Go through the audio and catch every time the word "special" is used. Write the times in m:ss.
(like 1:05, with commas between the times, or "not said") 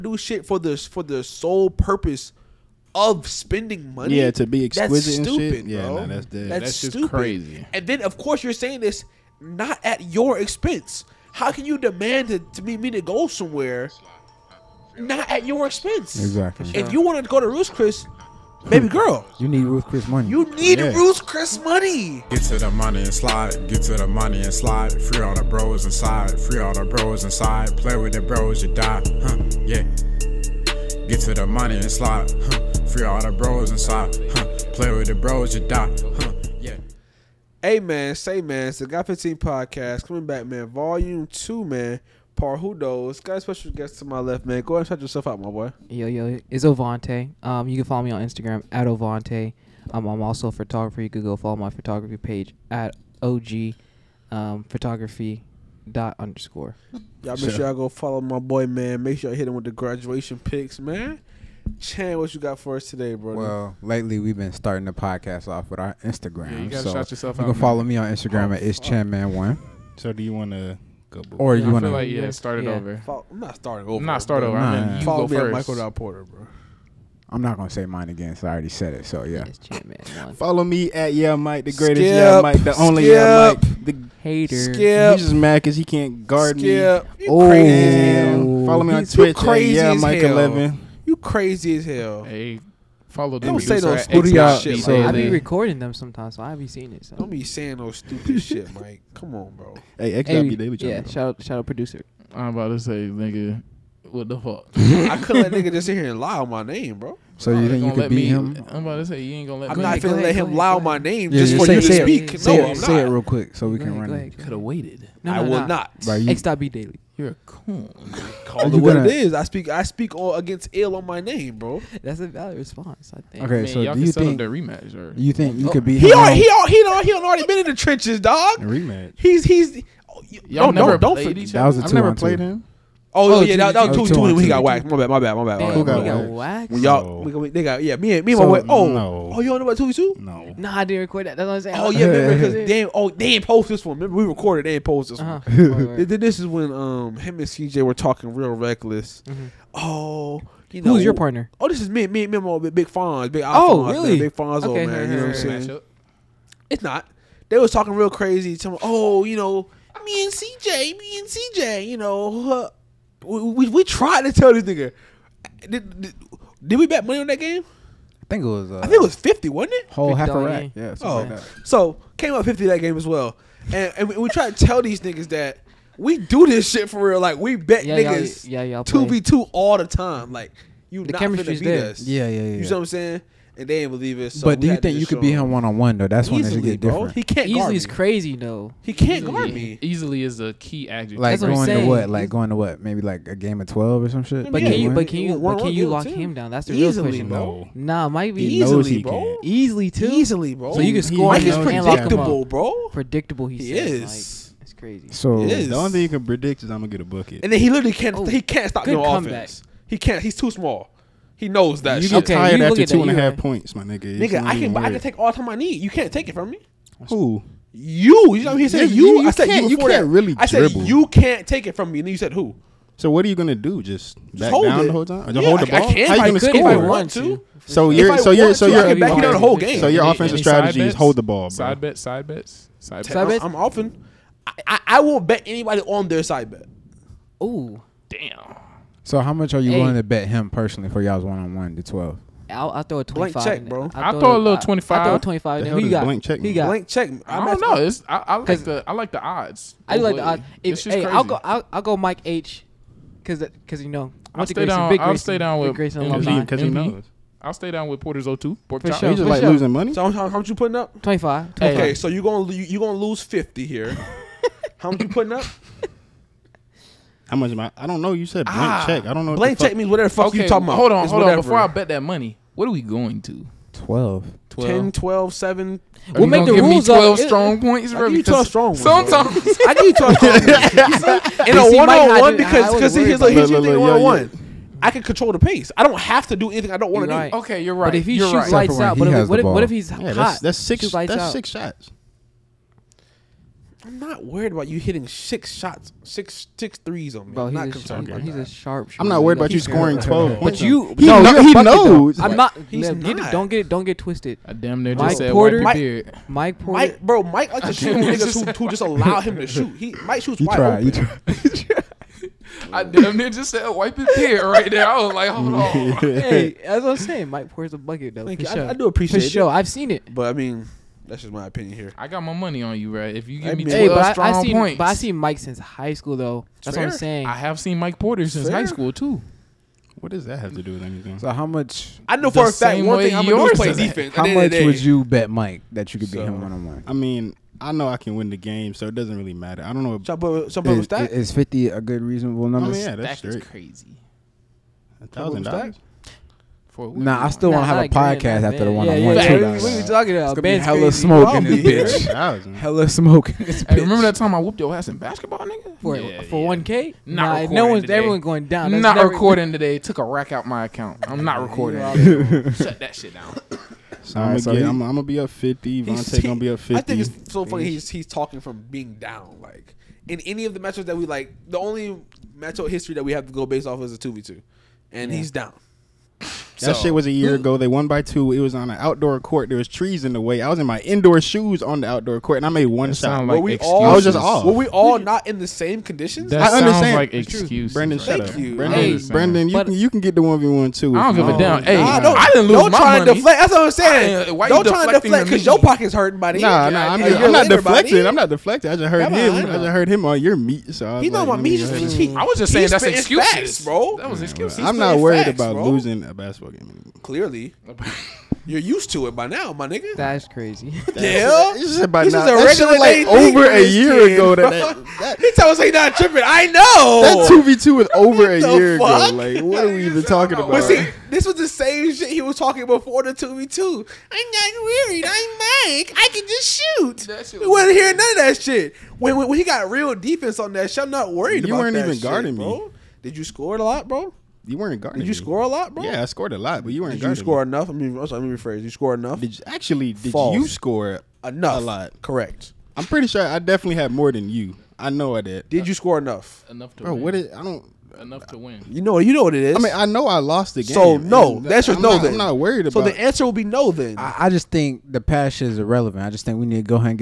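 0:43.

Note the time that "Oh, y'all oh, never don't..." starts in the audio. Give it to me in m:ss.
2:10.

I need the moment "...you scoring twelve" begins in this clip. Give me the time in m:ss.
4:59.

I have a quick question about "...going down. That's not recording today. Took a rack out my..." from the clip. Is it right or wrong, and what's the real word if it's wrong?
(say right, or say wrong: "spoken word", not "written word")
right.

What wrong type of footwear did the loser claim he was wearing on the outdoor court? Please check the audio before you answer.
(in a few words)
indoor shoes.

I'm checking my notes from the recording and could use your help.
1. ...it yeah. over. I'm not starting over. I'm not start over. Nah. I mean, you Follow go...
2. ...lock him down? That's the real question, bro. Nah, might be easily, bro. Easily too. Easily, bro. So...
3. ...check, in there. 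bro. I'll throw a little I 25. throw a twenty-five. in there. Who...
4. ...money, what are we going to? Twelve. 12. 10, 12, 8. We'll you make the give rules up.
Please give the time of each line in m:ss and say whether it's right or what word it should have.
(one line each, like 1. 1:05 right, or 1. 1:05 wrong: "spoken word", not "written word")
1. 1:12 right
2. 3:15 right
3. 4:03 right
4. 4:32 wrong: "7", not "8".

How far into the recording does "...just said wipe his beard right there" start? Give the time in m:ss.
5:13.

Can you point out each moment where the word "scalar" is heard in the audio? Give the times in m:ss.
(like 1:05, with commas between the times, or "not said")
not said.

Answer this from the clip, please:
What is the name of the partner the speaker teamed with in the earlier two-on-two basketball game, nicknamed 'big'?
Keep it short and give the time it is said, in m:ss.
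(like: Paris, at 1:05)
Alphonse, at 2:33.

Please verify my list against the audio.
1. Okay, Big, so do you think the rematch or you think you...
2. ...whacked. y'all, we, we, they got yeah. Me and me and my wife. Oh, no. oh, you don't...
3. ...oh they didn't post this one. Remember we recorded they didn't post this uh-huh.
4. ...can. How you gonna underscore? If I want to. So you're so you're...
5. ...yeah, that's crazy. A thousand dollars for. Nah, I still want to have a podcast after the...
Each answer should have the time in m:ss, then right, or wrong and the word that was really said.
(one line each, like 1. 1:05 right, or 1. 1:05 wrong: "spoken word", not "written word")
1. 2:03 wrong: "Man", not "Big"
2. 2:16 right
3. 2:22 right
4. 3:45 wrong: "score", not "underscore"
5. 5:42 right.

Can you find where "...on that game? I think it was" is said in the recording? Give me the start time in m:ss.
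2:47.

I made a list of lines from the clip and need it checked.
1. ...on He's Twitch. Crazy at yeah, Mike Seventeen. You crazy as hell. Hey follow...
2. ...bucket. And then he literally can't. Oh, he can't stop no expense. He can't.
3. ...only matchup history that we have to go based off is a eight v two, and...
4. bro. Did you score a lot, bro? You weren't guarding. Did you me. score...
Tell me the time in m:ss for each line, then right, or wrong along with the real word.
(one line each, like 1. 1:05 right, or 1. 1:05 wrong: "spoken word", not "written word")
1. 1:28 wrong: "Eleven", not "Seventeen"
2. 3:27 wrong: "offense", not "expense"
3. 6:11 wrong: "two", not "eight"
4. 7:12 right.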